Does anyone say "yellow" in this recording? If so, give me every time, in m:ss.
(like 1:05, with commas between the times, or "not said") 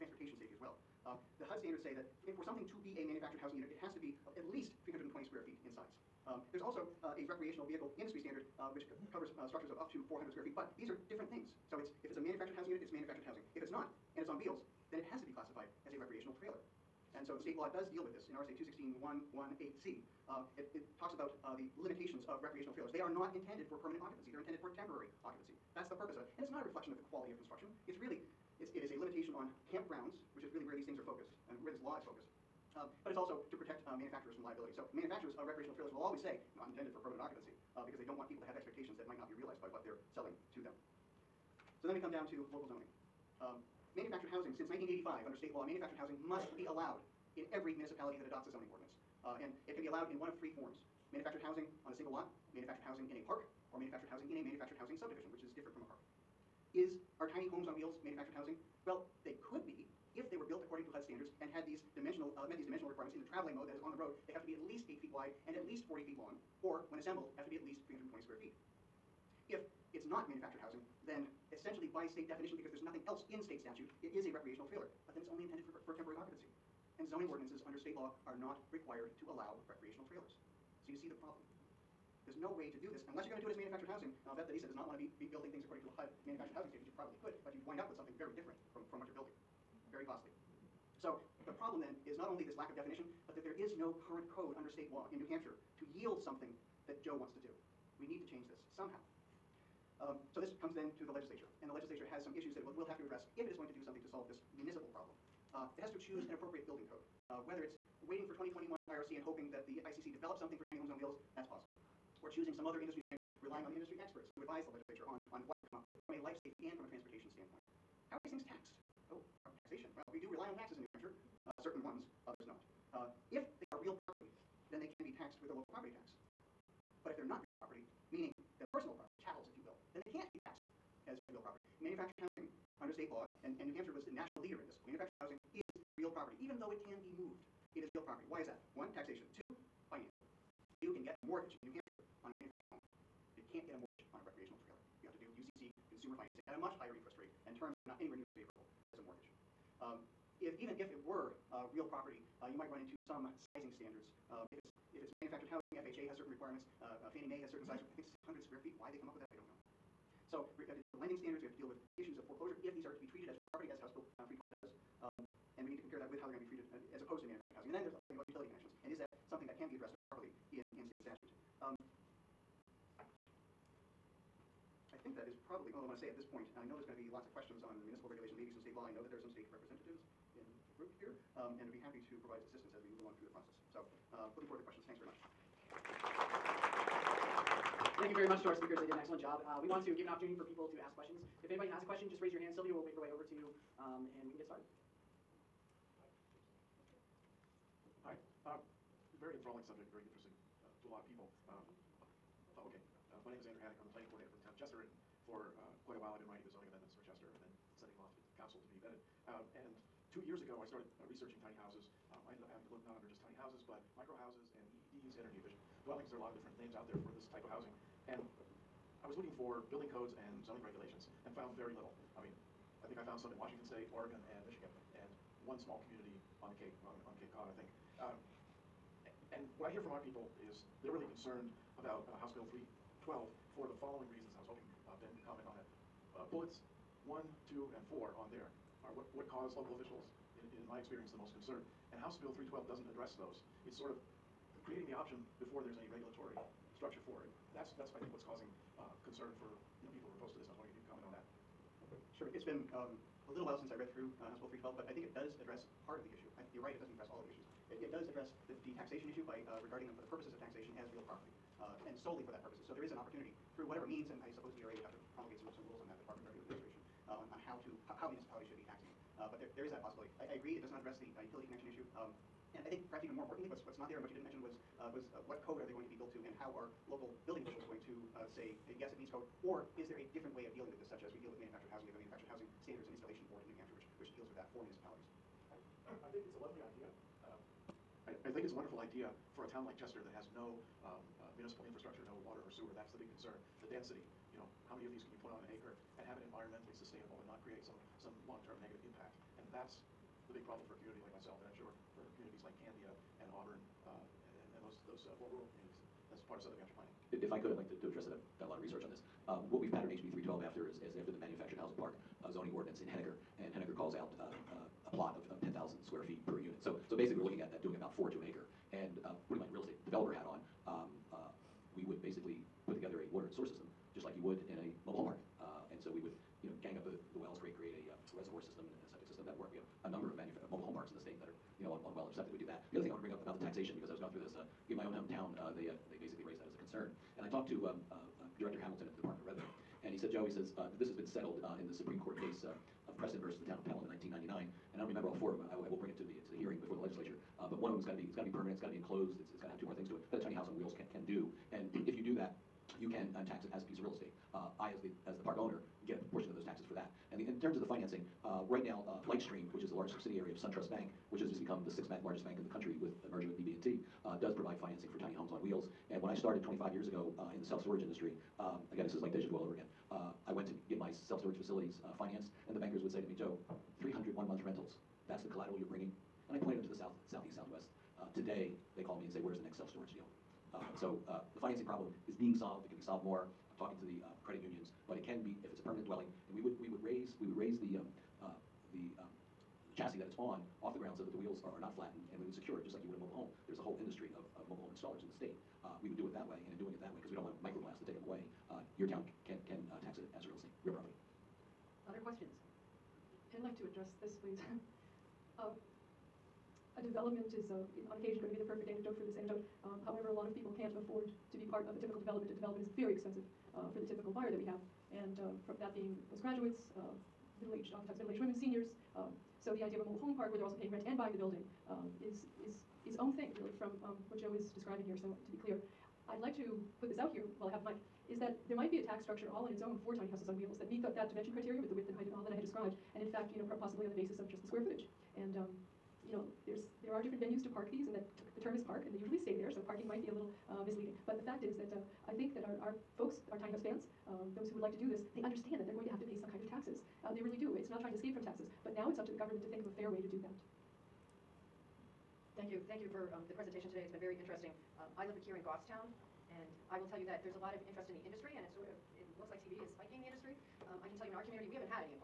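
not said.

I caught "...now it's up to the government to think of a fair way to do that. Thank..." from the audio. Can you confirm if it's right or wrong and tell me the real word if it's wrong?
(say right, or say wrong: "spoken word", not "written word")
right.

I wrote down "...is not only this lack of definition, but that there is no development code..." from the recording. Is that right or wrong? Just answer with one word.
wrong.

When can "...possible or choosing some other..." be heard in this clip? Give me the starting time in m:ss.
1:51.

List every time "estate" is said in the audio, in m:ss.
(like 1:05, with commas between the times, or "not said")
5:19, 5:53, 6:40.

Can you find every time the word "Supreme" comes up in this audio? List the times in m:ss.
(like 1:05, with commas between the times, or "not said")
5:41.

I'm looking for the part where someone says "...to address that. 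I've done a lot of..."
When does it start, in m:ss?
5:07.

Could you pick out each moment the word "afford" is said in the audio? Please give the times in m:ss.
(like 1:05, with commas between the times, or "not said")
6:50.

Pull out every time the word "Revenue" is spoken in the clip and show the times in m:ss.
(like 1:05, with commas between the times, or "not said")
4:26, 5:39.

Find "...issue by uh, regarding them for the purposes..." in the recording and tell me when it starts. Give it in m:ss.
4:19.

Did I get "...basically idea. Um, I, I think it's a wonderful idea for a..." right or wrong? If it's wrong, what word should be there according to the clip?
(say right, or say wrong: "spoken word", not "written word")
wrong: "lovely", not "basically".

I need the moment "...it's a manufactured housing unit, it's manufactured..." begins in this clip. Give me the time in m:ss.
0:12.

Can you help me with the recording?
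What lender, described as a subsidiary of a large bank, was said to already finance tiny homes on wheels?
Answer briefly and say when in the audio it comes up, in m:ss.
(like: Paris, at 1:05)
Lightstream, at 5:59.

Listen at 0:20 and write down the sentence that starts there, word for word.
Uh, it, it talks about uh, the limitations of recreational trailers.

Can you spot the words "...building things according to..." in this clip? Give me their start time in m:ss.
1:25.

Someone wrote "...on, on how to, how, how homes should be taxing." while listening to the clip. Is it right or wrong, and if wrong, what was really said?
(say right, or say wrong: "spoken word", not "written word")
wrong: "municipalities", not "homes".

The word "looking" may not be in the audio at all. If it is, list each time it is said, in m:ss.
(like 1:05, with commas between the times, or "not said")
3:39, 5:17.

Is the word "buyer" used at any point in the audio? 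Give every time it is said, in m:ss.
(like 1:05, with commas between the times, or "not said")
6:54.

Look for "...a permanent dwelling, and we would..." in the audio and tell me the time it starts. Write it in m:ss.
6:25.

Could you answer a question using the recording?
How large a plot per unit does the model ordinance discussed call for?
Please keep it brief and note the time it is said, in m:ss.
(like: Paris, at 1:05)
10,000 square feet, at 5:15.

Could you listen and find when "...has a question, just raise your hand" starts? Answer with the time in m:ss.
3:11.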